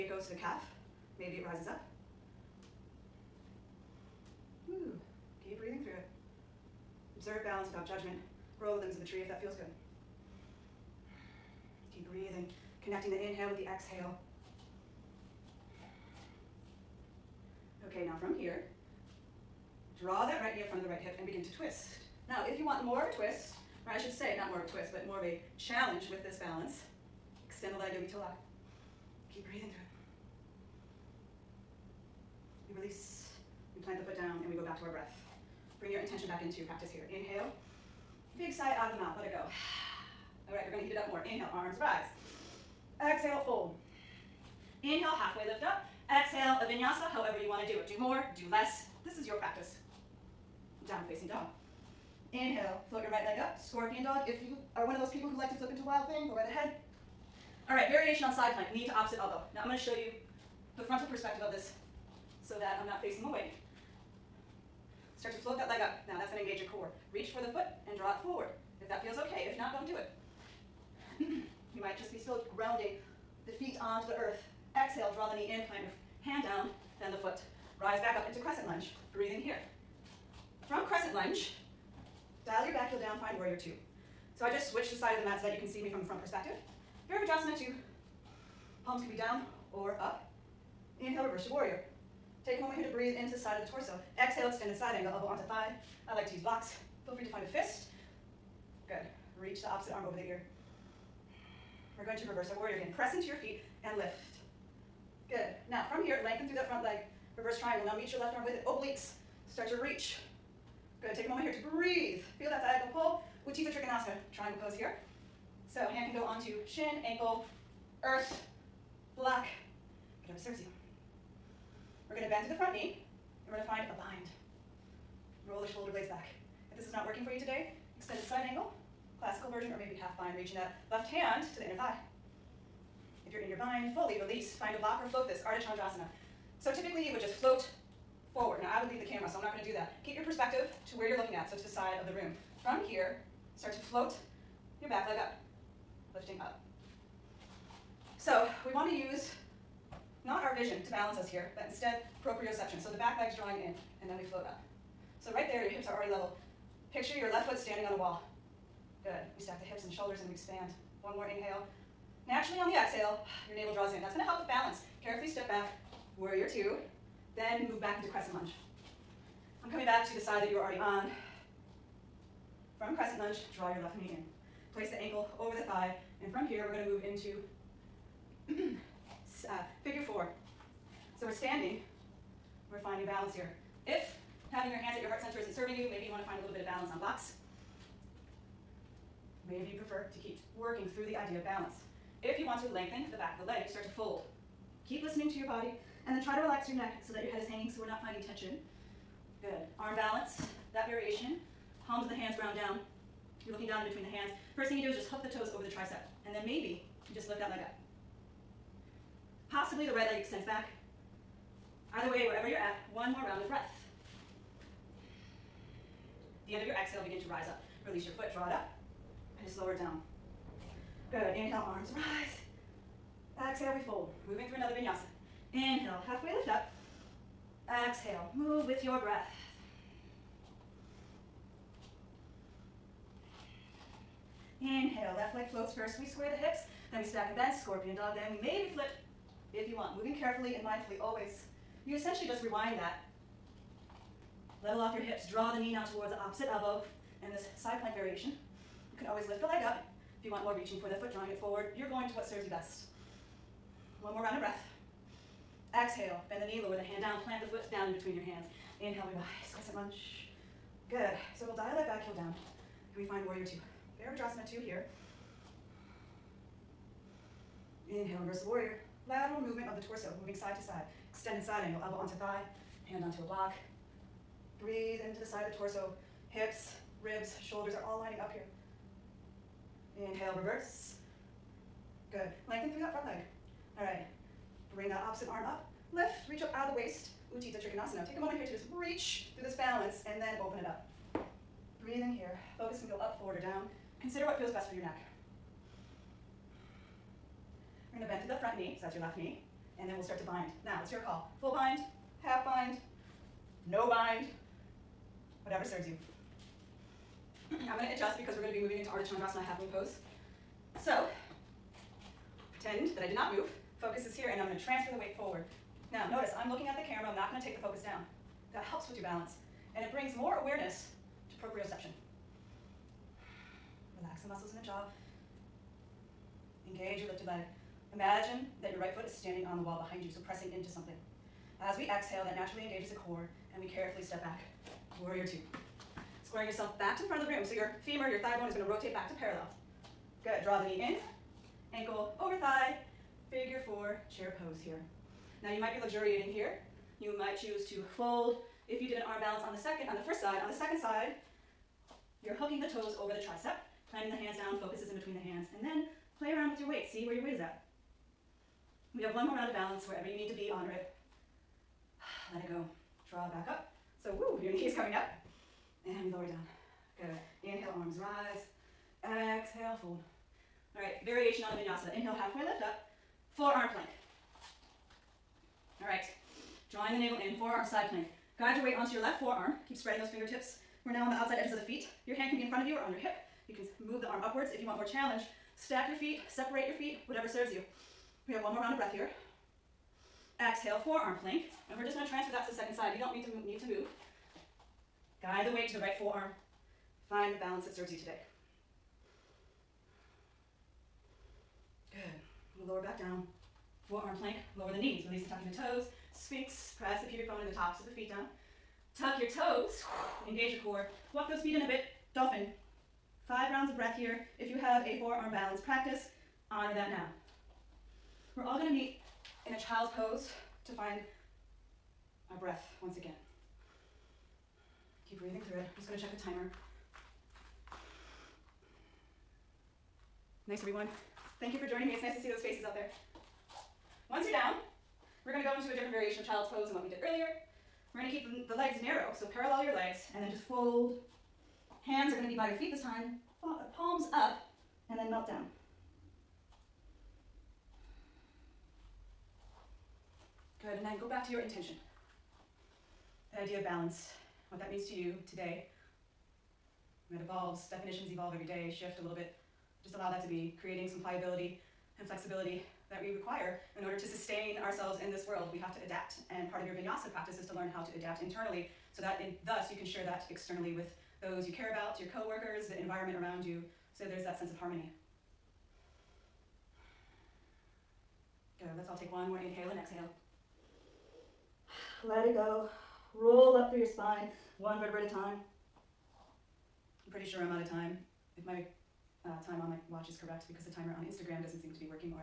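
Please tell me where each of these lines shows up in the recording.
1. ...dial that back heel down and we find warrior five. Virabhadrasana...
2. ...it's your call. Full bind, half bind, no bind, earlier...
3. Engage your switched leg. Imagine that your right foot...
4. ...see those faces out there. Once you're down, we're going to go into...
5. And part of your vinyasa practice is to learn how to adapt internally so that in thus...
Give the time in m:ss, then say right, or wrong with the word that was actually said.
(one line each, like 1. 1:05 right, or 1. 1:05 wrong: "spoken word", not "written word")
1. 4:21 wrong: "two", not "five"
2. 5:00 wrong: "whatever", not "earlier"
3. 5:26 wrong: "lifted", not "switched"
4. 7:12 right
5. 7:46 right.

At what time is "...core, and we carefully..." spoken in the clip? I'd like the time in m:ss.
5:32.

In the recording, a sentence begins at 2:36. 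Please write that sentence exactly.
Picture your left foot standing on a wall.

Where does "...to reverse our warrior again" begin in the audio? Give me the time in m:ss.
1:42.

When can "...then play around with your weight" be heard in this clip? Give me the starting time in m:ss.
5:55.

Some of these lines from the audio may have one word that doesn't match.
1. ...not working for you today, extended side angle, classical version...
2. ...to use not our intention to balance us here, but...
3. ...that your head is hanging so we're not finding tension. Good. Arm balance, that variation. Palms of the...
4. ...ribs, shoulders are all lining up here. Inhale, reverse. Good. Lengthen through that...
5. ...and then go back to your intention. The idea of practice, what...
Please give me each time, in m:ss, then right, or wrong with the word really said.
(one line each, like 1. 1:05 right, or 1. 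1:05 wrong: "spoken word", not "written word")
1. 2:06 right
2. 2:28 wrong: "vision", not "intention"
3. 3:17 right
4. 4:37 right
5. 7:30 wrong: "balance", not "practice".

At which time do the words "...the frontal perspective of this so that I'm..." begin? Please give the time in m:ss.
1:00.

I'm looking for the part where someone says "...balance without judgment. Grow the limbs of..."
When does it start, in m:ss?
0:07.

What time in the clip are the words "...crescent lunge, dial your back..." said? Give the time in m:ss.
1:20.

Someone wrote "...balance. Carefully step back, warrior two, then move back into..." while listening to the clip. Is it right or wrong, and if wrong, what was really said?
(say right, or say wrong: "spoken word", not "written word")
right.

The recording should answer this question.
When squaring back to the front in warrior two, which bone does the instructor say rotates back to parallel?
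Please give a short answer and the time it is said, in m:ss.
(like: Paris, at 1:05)
femur, at 5:37.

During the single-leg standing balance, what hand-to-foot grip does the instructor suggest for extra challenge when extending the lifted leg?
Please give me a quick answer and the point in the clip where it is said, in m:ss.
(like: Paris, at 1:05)
yogi toe lock, at 0:27.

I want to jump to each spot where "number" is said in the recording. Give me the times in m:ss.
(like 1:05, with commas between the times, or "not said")
not said.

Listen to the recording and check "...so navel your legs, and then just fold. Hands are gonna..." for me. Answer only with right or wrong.
wrong.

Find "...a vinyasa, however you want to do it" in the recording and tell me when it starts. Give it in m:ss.
0:46.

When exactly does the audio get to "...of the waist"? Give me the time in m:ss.
4:46.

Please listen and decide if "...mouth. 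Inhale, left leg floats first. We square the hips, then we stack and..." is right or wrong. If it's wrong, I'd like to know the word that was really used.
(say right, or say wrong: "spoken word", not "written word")
wrong: "breath", not "mouth".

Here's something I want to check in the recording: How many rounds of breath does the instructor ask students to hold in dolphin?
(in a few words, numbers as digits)
5.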